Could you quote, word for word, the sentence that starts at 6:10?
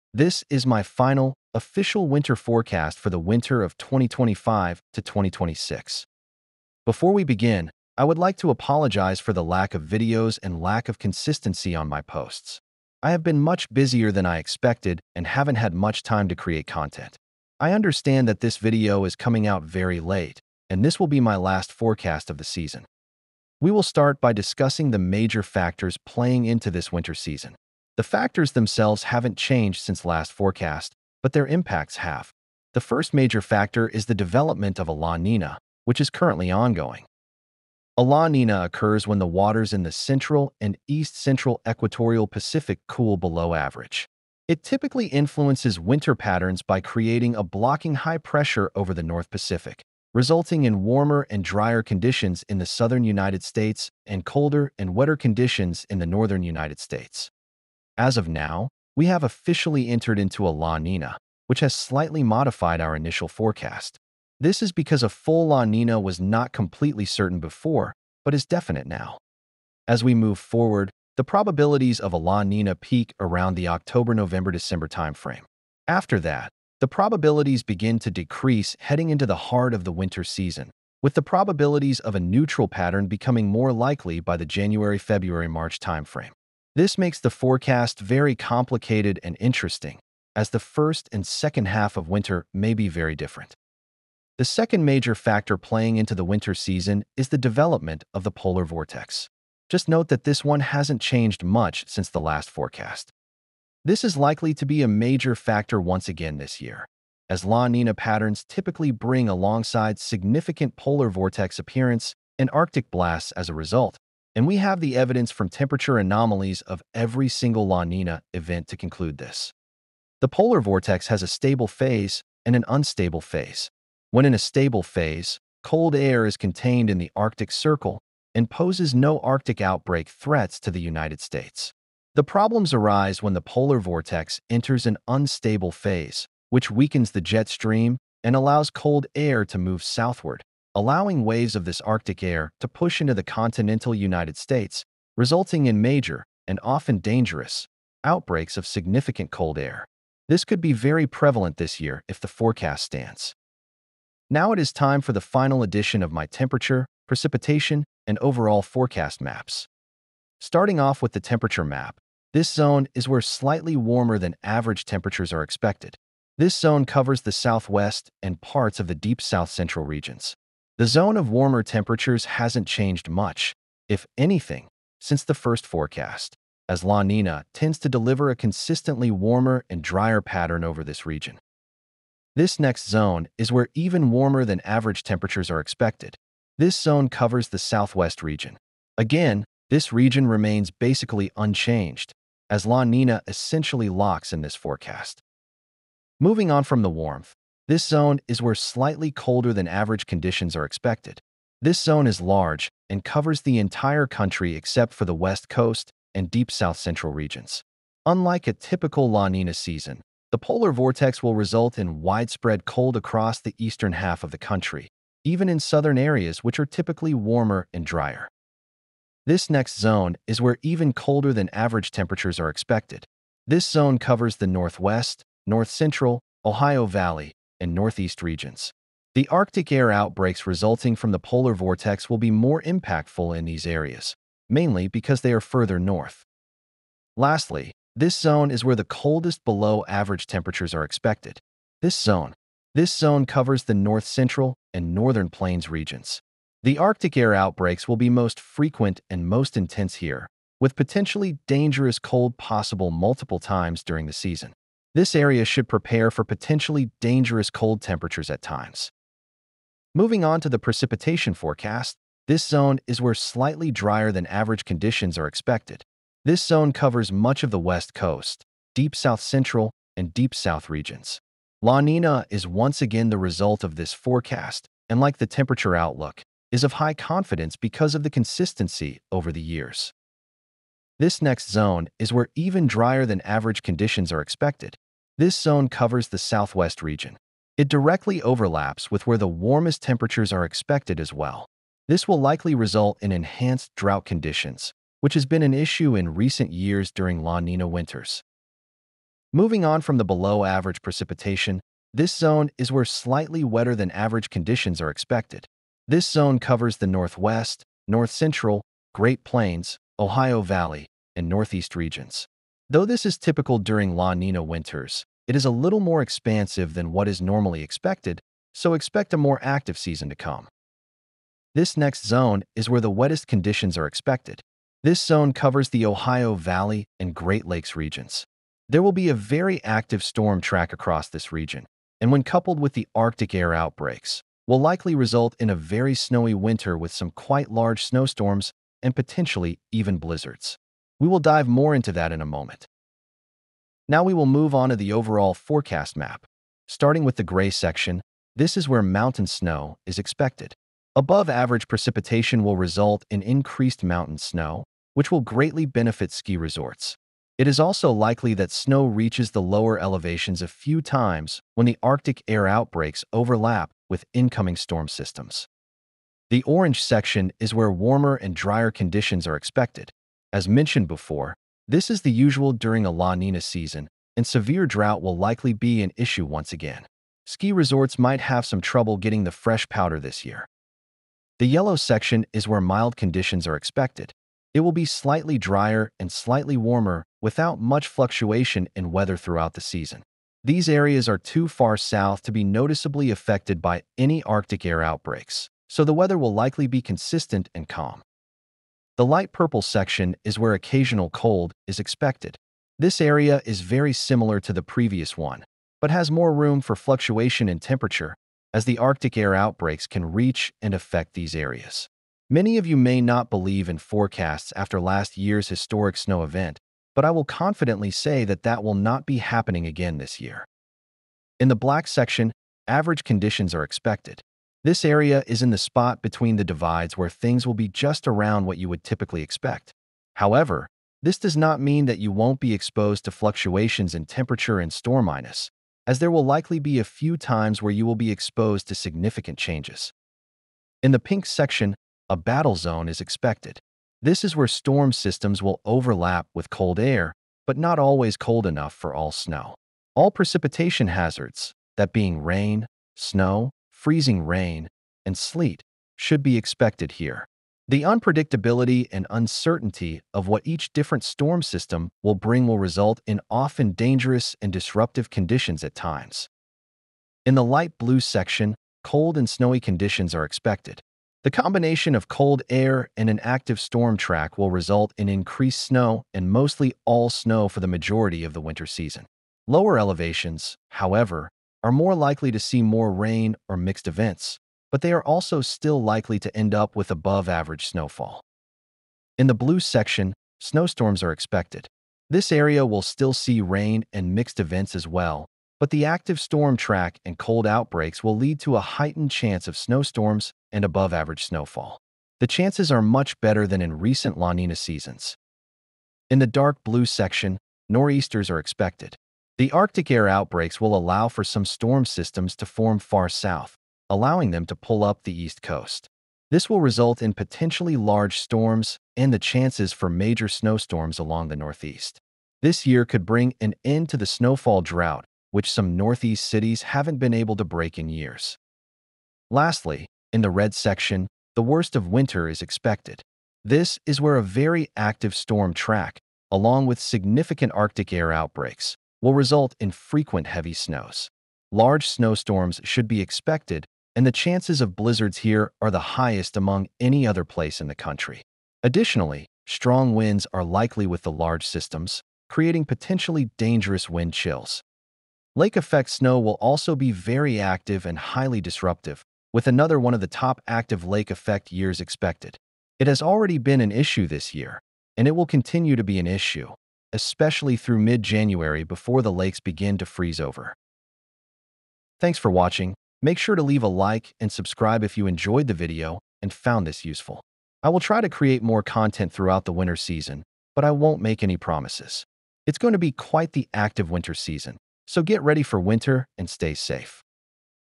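As mentioned before, this is the usual during a La Nina season, and severe drought will likely be an issue once again.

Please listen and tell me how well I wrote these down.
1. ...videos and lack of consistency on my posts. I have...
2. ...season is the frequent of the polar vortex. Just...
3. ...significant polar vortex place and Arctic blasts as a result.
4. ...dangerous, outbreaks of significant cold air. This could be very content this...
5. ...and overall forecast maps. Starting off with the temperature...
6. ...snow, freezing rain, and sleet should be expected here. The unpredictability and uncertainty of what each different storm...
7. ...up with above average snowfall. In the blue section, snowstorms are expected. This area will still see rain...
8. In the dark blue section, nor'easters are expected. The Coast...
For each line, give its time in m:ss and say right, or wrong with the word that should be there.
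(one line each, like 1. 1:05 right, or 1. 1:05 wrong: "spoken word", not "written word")
1. 0:09 right
2. 1:36 wrong: "development", not "frequent"
3. 1:49 wrong: "appearance", not "place"
4. 2:26 wrong: "prevalent", not "content"
5. 2:38 right
6. 7:32 right
7. 8:06 right
8. 8:26 wrong: "Arctic", not "Coast".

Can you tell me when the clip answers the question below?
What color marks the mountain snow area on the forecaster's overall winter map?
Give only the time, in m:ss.
5:47.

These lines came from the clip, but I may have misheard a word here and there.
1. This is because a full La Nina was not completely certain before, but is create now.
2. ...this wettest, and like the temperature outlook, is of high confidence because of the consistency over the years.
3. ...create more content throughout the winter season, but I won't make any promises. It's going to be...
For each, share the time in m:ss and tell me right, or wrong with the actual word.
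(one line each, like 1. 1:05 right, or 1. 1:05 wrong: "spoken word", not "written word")
1. 1:04 wrong: "definite", not "create"
2. 4:33 wrong: "forecast", not "wettest"
3. 9:38 right.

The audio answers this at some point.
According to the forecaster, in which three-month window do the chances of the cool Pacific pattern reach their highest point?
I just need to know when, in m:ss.
1:13.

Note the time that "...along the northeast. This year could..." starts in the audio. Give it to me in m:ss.
8:40.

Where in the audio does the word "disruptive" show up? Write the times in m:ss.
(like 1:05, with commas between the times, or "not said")
7:44, 9:18.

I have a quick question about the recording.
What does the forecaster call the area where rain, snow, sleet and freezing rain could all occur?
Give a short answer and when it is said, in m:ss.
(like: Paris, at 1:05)
Battle zone, at 7:22.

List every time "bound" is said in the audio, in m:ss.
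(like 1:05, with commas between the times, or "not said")
not said.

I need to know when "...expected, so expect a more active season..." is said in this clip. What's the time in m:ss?
5:17.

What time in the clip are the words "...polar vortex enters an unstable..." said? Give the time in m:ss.
2:13.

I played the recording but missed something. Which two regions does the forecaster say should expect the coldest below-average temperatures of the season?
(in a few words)
North central and northern plains.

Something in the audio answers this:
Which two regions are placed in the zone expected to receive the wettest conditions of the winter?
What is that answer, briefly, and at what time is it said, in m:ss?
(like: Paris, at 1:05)
Ohio Valley and Great Lakes, at 5:25.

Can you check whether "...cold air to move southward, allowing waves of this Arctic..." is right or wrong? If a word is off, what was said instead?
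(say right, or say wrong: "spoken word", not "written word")
right.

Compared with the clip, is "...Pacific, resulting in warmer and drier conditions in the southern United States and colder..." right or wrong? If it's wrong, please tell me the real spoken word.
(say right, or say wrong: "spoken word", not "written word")
right.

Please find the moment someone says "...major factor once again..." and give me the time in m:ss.
1:44.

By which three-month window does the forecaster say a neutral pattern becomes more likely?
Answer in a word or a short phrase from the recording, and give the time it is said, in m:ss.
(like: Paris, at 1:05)
January-February-March, at 1:24.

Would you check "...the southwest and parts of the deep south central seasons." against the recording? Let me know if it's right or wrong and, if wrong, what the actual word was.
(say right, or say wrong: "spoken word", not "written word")
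wrong: "regions", not "seasons".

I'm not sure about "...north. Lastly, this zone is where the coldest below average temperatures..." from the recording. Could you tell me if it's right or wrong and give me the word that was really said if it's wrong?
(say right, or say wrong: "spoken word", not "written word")
right.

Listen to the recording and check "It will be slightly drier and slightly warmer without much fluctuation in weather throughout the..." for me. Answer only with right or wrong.
right.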